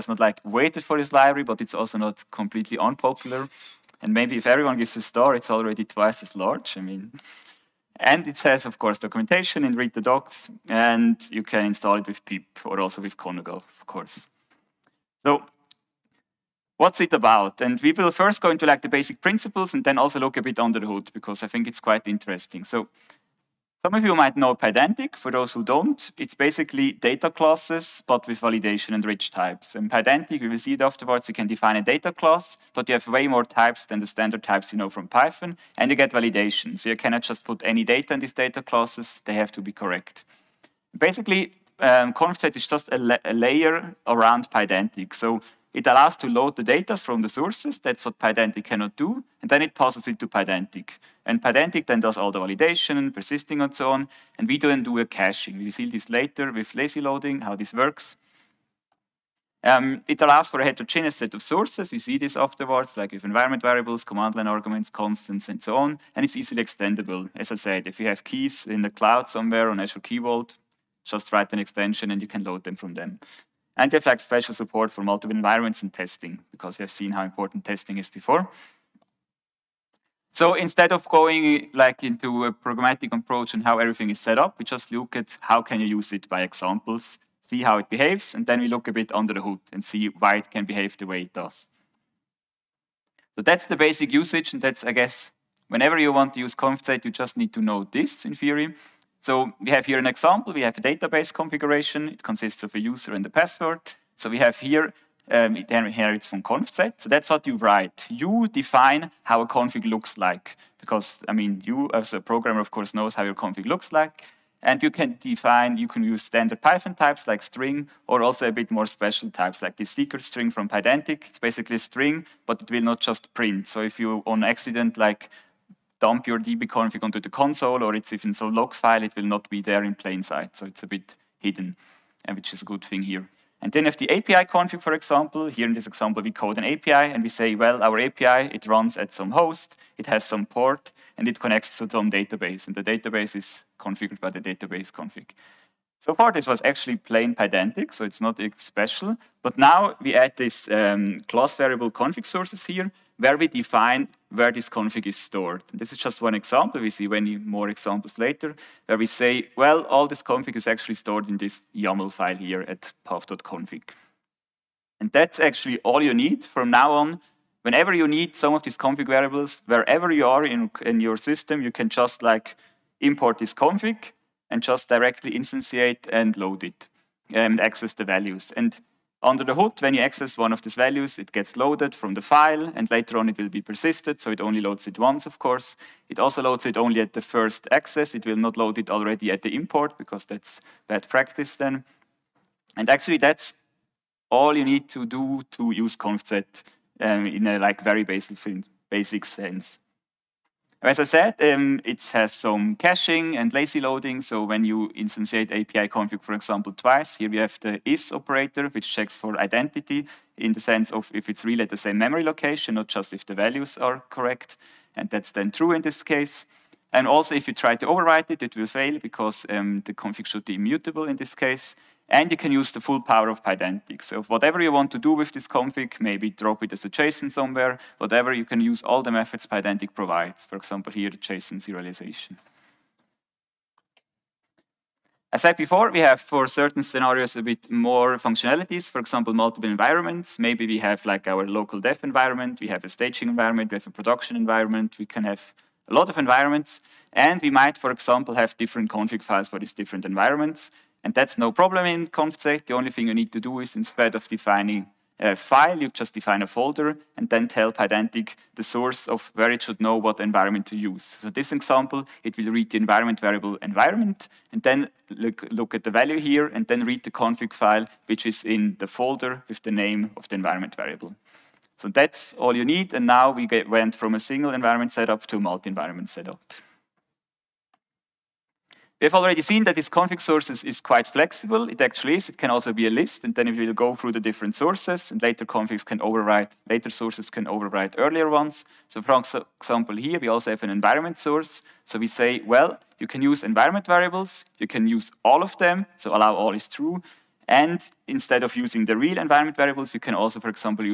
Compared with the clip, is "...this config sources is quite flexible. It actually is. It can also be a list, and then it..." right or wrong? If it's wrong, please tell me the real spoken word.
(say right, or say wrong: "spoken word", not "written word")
right.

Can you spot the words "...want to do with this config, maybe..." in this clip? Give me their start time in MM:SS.
03:44.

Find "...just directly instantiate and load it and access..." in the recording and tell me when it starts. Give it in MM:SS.
02:54.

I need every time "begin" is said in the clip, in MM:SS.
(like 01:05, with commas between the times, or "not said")
not said.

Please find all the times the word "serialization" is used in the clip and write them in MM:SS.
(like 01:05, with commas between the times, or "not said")
03:51.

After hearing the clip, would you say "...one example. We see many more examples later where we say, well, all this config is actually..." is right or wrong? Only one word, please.
right.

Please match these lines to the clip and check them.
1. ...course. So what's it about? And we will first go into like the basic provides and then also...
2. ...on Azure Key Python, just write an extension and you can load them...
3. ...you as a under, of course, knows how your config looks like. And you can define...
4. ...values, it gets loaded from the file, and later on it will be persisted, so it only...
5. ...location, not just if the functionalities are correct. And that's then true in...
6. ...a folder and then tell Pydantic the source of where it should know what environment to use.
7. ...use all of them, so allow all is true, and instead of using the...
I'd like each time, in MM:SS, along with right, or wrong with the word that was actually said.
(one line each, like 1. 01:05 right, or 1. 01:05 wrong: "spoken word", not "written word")
1. 00:13 wrong: "principles", not "provides"
2. 01:09 wrong: "Vault", not "Python"
3. 01:51 wrong: "programmer", not "under"
4. 03:00 right
5. 03:32 wrong: "values", not "functionalities"
6. 04:16 right
7. 04:54 right.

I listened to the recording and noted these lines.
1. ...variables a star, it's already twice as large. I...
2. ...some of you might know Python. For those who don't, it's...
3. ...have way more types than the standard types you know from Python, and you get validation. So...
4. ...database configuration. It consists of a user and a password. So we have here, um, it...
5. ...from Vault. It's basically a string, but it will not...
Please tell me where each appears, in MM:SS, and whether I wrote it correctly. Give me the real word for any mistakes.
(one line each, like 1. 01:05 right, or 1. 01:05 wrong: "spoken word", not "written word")
1. 00:04 wrong: "gives", not "variables"
2. 00:23 wrong: "Pydantic", not "Python"
3. 00:32 right
4. 01:40 right
5. 02:00 wrong: "Pydantic", not "Vault".